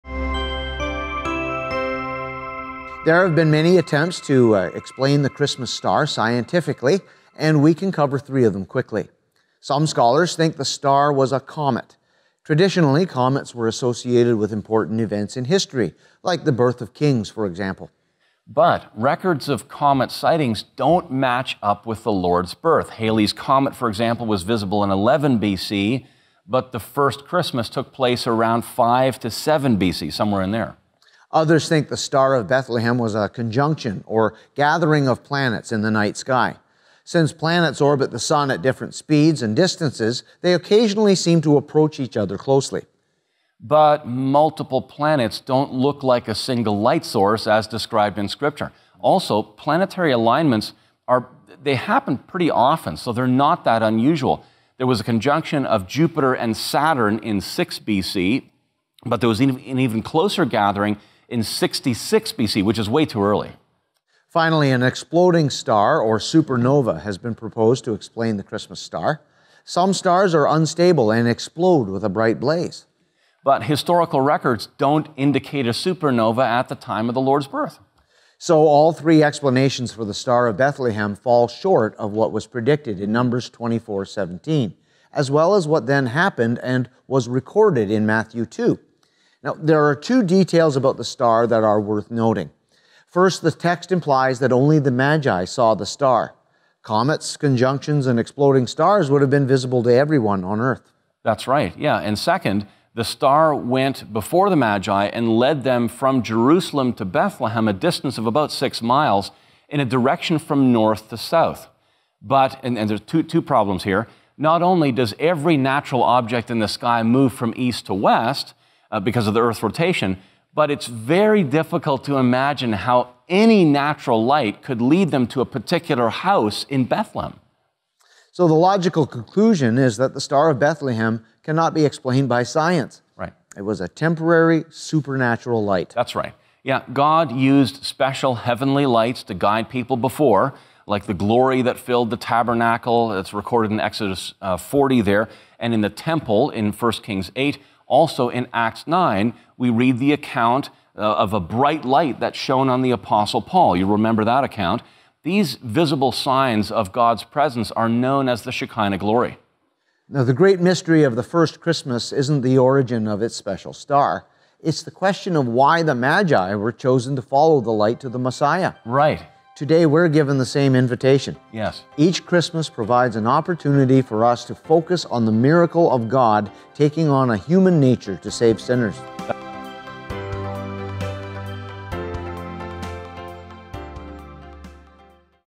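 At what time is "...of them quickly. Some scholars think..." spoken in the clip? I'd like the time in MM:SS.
00:08.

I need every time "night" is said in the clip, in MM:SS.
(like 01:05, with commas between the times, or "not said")
00:35.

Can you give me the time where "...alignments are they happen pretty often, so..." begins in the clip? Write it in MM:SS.
00:50.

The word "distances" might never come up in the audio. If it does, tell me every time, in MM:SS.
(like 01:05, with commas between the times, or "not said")
00:39, 01:47.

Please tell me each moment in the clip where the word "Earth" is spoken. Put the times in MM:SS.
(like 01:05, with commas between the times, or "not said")
01:40, 01:59.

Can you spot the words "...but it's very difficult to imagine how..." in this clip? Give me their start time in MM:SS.
02:00.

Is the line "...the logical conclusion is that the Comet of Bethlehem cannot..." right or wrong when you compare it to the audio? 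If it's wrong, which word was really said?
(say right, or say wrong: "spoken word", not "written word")
wrong: "Star", not "Comet".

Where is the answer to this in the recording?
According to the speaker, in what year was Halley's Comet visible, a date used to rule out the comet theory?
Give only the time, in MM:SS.
00:24.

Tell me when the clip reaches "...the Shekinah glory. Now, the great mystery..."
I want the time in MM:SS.
02:38.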